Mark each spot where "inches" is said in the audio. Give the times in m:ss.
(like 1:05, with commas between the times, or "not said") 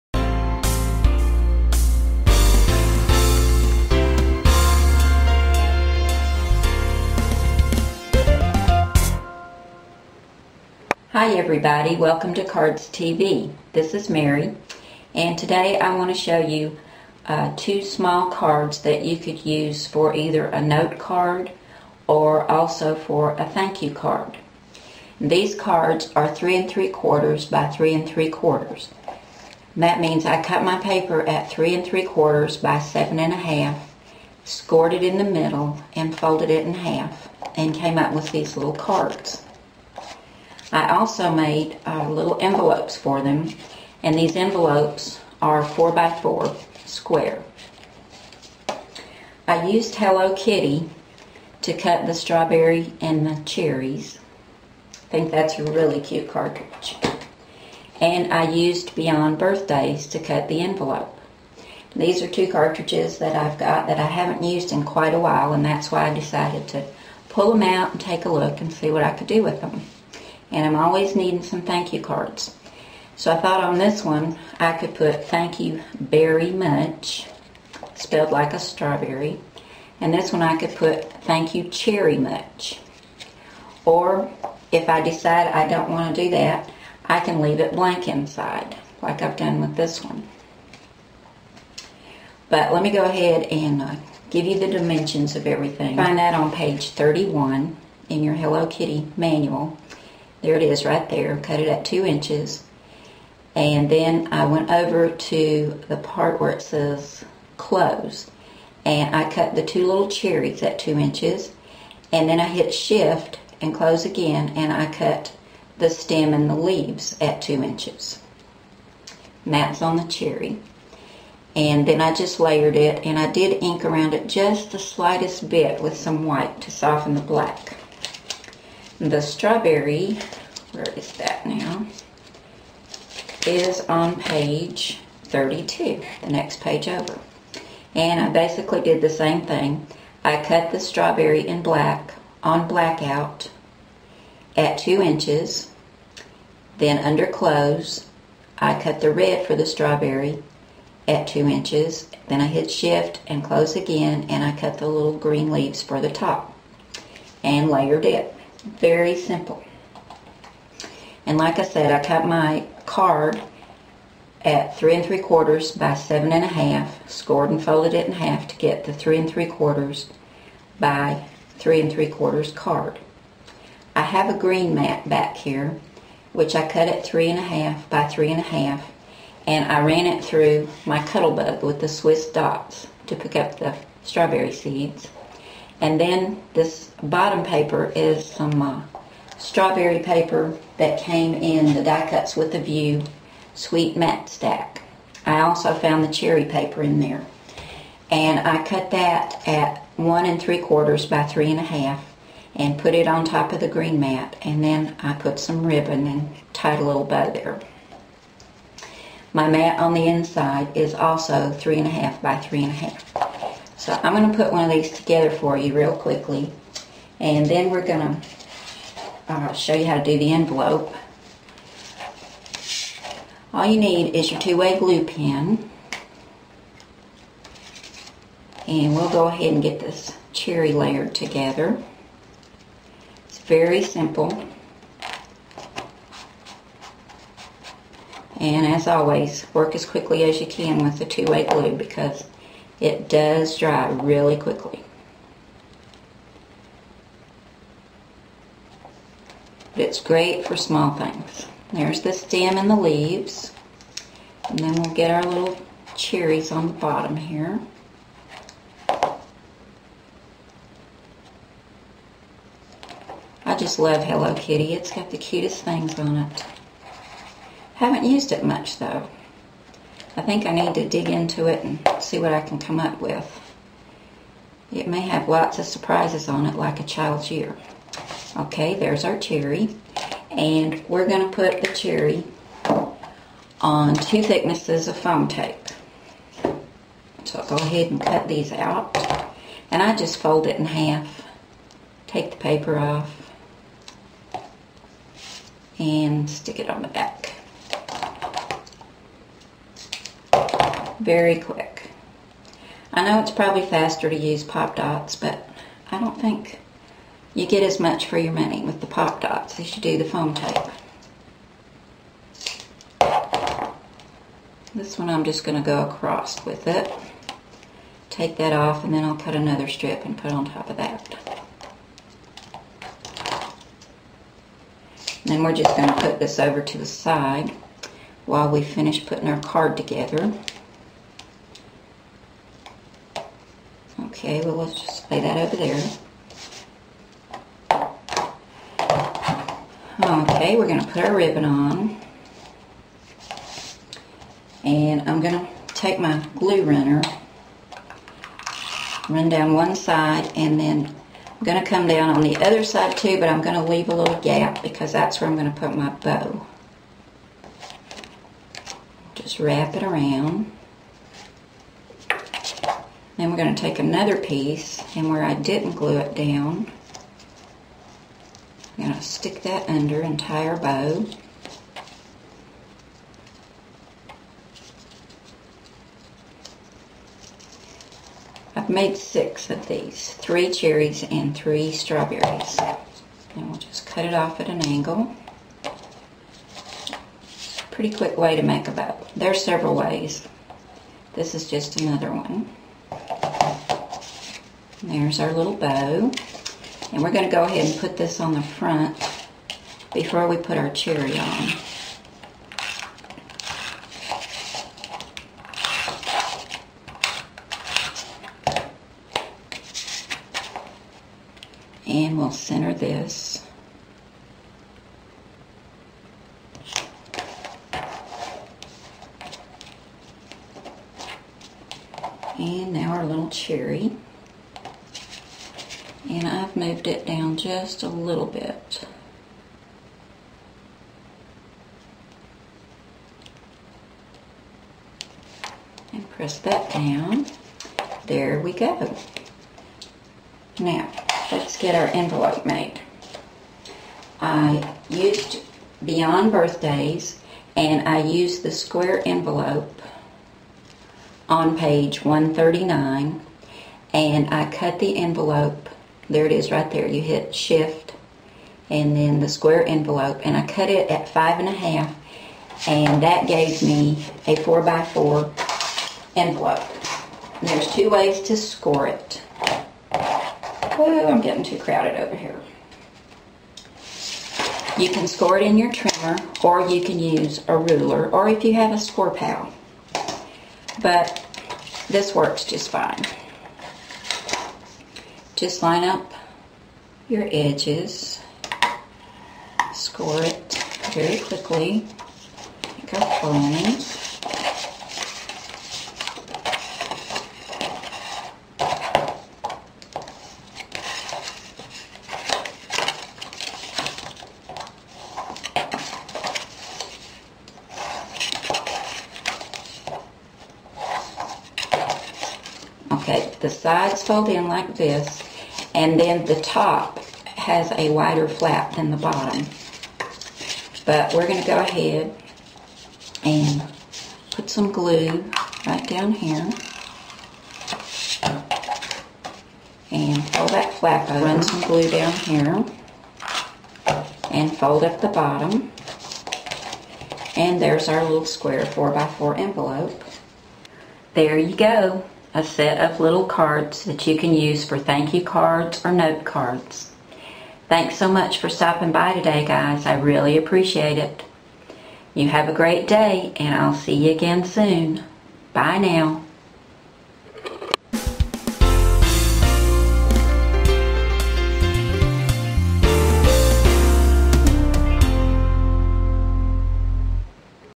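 1:42, 1:50, 1:57, 2:25, 2:31.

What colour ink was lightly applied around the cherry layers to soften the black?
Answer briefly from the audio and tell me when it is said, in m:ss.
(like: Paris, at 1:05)
White, at 2:06.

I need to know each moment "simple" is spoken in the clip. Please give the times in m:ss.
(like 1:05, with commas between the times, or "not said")
2:39, 3:53.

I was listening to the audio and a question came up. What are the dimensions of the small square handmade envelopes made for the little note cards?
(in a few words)
4 by 4.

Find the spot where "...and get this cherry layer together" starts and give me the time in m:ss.
3:49.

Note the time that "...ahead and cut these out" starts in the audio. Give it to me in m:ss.
4:47.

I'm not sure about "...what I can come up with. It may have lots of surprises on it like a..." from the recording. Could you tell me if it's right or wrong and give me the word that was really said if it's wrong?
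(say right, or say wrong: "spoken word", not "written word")
right.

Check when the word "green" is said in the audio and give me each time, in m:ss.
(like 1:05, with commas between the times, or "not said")
2:35, 2:54, 3:23.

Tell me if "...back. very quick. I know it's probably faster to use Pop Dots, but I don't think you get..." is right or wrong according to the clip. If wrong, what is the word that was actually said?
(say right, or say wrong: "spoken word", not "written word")
right.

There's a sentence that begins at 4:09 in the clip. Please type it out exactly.
But it's great for small things.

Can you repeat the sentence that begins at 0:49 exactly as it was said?
I used Hello Kitty to cut the strawberry and the cherries.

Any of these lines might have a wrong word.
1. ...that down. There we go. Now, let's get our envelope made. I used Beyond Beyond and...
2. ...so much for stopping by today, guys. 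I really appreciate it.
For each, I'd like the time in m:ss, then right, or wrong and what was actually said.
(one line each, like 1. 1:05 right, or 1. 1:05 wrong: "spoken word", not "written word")
1. 7:16 wrong: "Birthdays", not "Beyond"
2. 9:07 right.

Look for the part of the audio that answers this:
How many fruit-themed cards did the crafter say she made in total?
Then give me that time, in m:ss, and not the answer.
6:18.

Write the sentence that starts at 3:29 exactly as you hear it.
My mat on the inside is also three and a half by three and a half.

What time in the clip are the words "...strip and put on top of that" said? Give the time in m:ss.
5:19.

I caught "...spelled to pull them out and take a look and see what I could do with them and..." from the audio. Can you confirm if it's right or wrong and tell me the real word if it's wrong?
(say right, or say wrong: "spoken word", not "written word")
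wrong: "decided", not "spelled".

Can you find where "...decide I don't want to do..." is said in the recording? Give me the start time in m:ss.
1:25.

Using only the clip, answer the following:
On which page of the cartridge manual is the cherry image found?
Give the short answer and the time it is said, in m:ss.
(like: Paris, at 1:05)
31, at 1:36.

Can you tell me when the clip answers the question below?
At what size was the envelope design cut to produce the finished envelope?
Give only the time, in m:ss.
7:41.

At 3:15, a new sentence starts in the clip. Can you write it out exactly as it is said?
I also found the cherry paper in there.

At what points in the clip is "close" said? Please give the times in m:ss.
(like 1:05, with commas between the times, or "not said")
1:47, 1:53, 2:27, 2:33.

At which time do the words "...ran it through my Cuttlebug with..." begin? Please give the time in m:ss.
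2:59.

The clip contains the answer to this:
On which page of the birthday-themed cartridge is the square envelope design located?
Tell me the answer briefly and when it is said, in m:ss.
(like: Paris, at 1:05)
139, at 7:31.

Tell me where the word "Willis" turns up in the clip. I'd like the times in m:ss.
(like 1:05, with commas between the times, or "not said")
not said.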